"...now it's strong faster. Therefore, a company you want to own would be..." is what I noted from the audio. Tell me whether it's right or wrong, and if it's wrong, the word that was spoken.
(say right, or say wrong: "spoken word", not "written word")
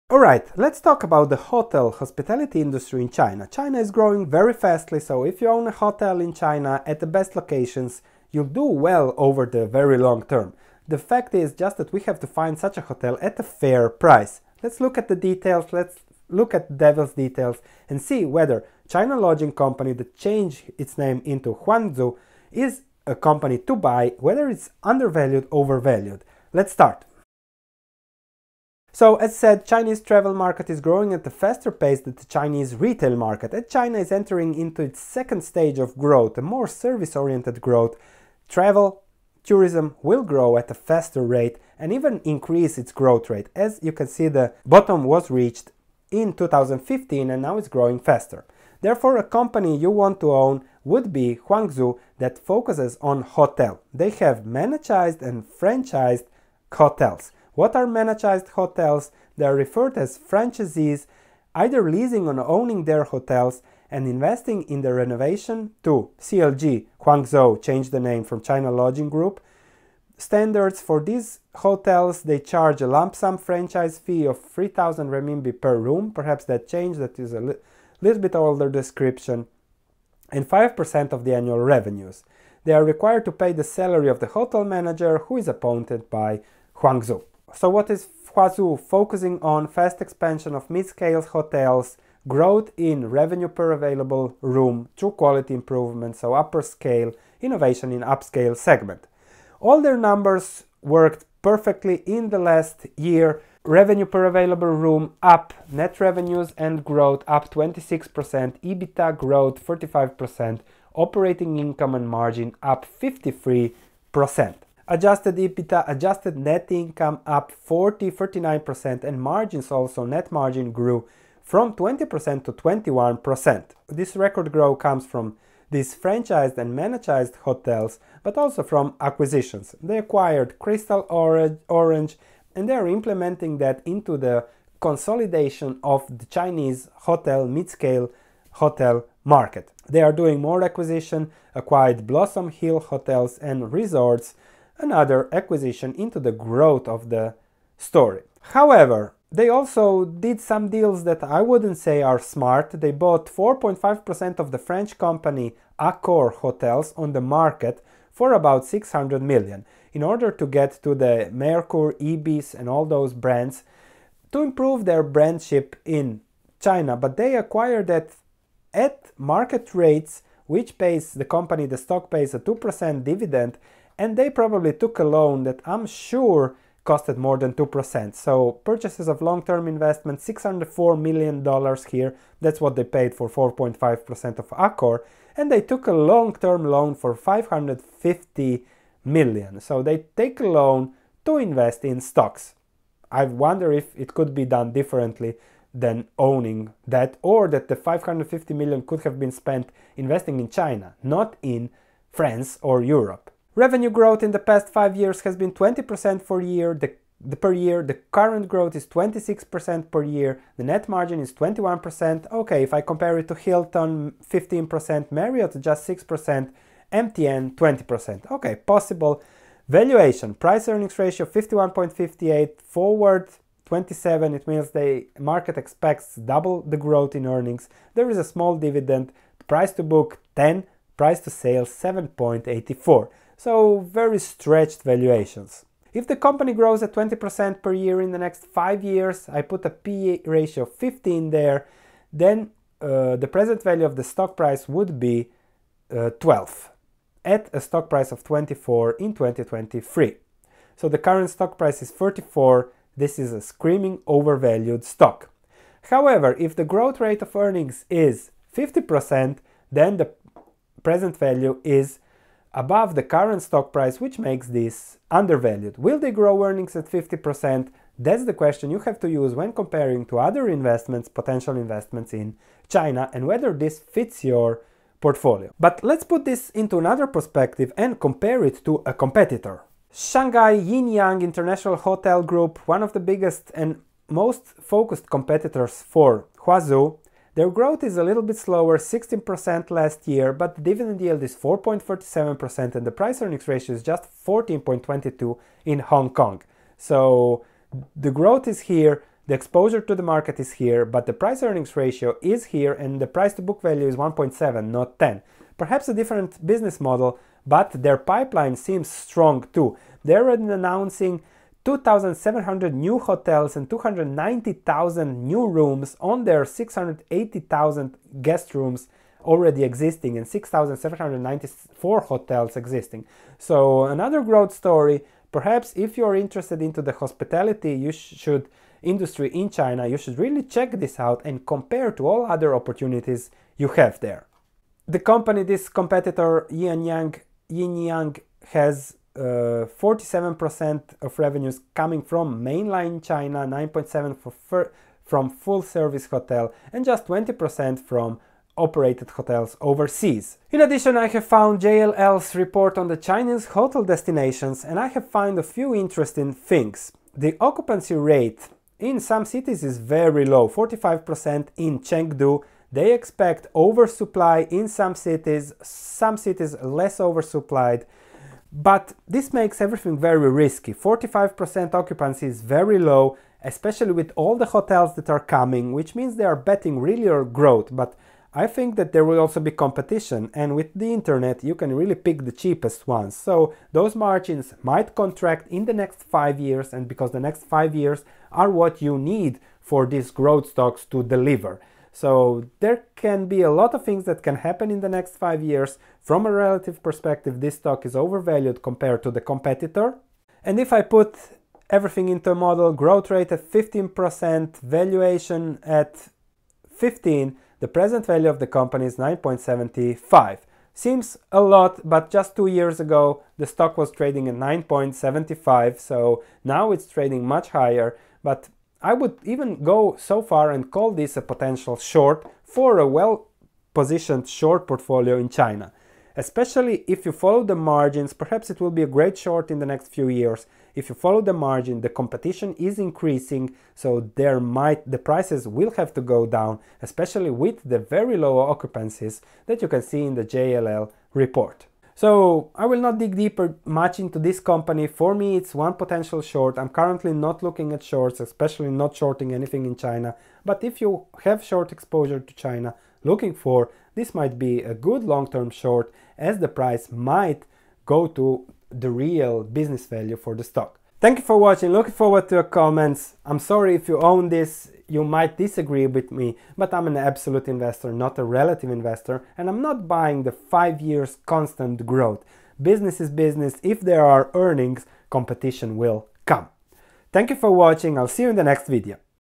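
wrong: "growing", not "strong".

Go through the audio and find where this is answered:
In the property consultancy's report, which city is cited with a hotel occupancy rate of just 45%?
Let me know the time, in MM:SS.
06:01.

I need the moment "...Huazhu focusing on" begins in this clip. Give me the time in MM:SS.
01:28.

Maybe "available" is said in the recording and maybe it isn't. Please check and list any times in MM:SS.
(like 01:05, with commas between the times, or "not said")
01:33, 01:44.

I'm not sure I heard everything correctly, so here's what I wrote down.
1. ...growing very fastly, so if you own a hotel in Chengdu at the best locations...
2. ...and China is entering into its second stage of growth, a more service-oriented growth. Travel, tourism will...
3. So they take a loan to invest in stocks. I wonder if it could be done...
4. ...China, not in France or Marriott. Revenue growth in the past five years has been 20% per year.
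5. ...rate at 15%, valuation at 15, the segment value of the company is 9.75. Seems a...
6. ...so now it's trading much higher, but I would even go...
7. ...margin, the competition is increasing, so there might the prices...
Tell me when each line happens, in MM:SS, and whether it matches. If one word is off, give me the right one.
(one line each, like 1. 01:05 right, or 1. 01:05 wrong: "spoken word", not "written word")
1. 00:03 wrong: "China", not "Chengdu"
2. 00:33 right
3. 03:09 right
4. 03:20 wrong: "Europe", not "Marriott"
5. 06:43 wrong: "present", not "segment"
6. 06:55 right
7. 07:11 right.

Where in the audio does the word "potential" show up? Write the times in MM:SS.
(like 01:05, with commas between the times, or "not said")
04:31, 07:01, 07:25.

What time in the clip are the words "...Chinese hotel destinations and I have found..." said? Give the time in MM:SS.
05:52.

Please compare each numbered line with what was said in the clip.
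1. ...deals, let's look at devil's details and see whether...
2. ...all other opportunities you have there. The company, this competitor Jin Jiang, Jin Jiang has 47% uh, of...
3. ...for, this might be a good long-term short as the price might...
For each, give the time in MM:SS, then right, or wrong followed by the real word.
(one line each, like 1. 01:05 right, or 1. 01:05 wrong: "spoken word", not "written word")
1. 00:15 wrong: "details", not "deals"
2. 05:32 right
3. 07:33 right.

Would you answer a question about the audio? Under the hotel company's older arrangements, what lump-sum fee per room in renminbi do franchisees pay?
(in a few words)
3000 renminbi.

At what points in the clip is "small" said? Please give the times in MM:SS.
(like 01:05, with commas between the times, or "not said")
03:48.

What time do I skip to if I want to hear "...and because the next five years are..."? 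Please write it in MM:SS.
06:26.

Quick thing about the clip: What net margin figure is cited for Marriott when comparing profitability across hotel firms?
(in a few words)
6%.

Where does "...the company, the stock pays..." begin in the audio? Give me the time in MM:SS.
02:51.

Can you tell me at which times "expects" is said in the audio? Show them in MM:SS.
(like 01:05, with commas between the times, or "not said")
03:45, 06:02.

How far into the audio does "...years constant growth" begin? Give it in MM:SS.
07:50.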